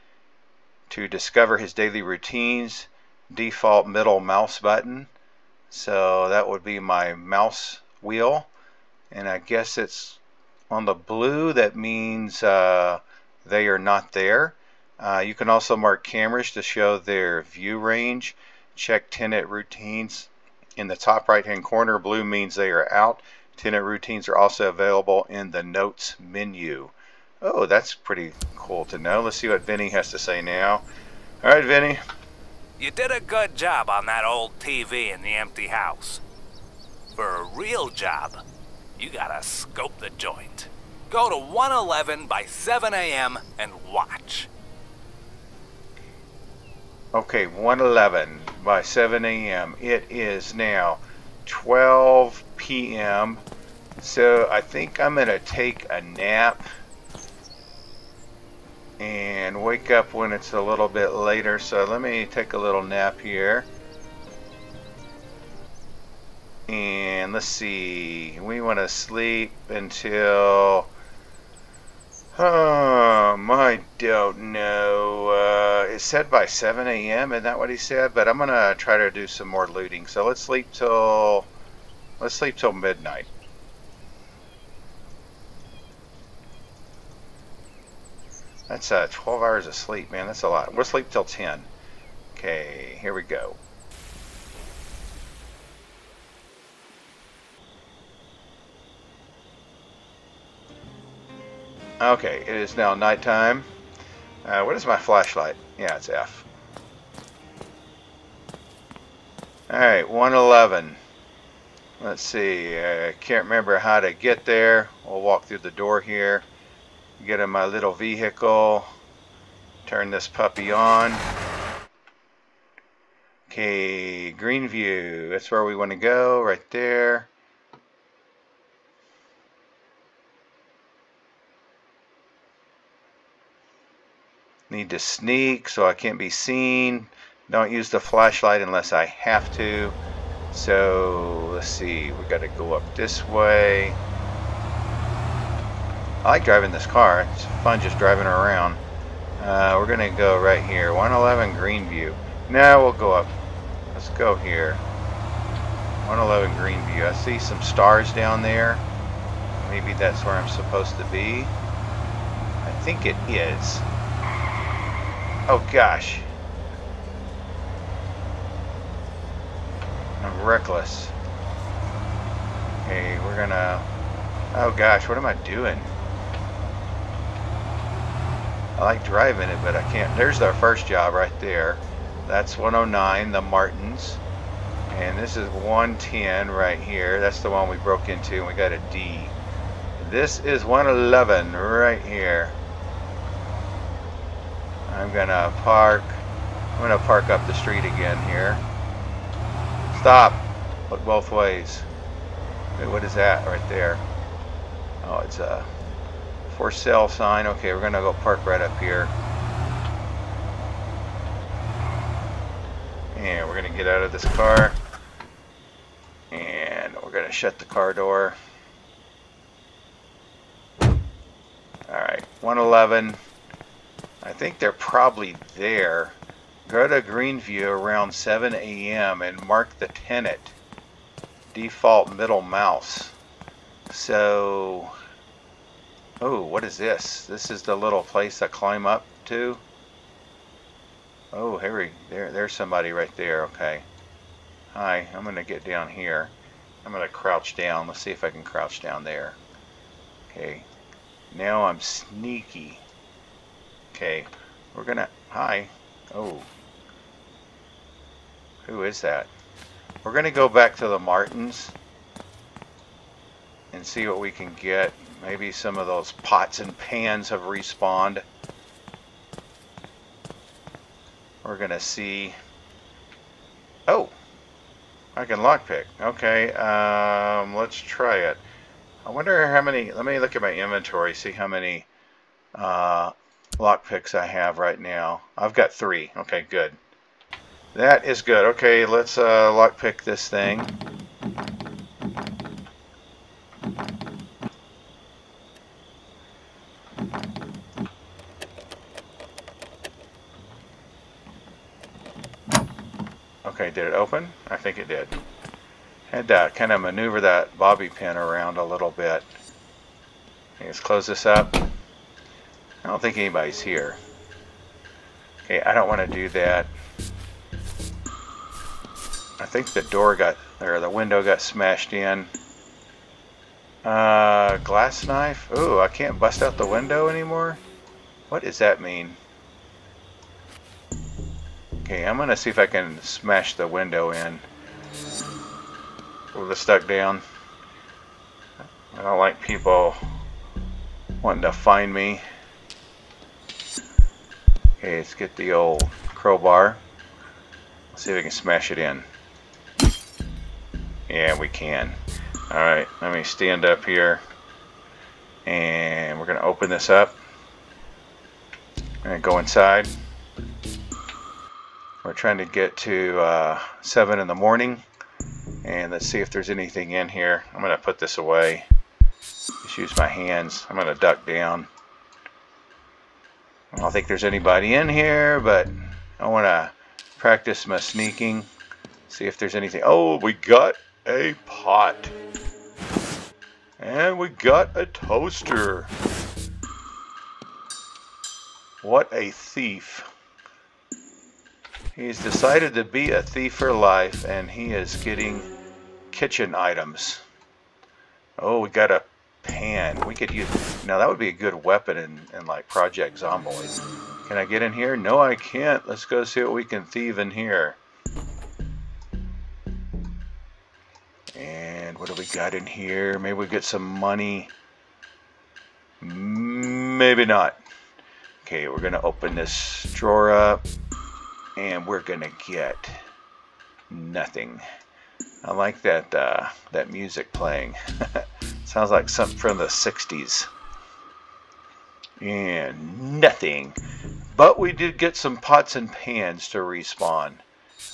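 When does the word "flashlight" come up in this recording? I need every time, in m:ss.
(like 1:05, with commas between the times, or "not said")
1:44, 2:17.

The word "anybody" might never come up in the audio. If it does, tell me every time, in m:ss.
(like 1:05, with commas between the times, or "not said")
5:13, 6:14.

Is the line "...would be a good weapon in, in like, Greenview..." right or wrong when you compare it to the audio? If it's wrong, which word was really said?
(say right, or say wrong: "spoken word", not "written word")
wrong: "Project", not "Greenview".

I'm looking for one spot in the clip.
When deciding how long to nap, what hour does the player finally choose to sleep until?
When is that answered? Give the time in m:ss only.
1:30.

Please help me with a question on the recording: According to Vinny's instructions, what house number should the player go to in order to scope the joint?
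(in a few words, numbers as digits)
111.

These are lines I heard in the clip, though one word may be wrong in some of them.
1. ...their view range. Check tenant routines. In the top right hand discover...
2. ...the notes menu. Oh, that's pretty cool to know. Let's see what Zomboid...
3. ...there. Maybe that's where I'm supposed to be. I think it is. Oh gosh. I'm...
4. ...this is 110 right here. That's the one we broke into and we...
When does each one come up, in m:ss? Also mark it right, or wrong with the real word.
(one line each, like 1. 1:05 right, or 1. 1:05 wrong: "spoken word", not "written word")
1. 0:16 wrong: "corner", not "discover"
2. 0:25 wrong: "Vinny", not "Zomboid"
3. 2:38 right
4. 3:05 right.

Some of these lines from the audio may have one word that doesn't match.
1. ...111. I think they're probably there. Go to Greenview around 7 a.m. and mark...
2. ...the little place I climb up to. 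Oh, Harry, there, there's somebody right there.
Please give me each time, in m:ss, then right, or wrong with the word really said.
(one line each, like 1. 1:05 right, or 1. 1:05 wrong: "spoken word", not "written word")
1. 3:42 right
2. 3:57 right.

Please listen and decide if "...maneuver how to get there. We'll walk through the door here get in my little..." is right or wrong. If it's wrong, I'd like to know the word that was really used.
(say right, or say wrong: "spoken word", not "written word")
wrong: "remember", not "maneuver".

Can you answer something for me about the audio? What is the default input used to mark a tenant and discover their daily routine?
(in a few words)
Middle mouse button.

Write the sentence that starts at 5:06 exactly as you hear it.
that, kind of maneuver that bobby pin around a little bit.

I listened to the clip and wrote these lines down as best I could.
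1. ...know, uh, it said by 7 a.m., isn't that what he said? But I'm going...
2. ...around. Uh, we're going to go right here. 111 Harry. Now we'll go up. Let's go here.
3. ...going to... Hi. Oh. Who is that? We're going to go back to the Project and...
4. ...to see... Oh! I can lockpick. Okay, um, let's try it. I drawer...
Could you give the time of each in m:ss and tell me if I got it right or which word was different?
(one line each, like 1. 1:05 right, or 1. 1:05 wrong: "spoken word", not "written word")
1. 1:14 right
2. 2:28 wrong: "Greenview", not "Harry"
3. 4:14 wrong: "Martins", not "Project"
4. 4:31 wrong: "wonder", not "drawer".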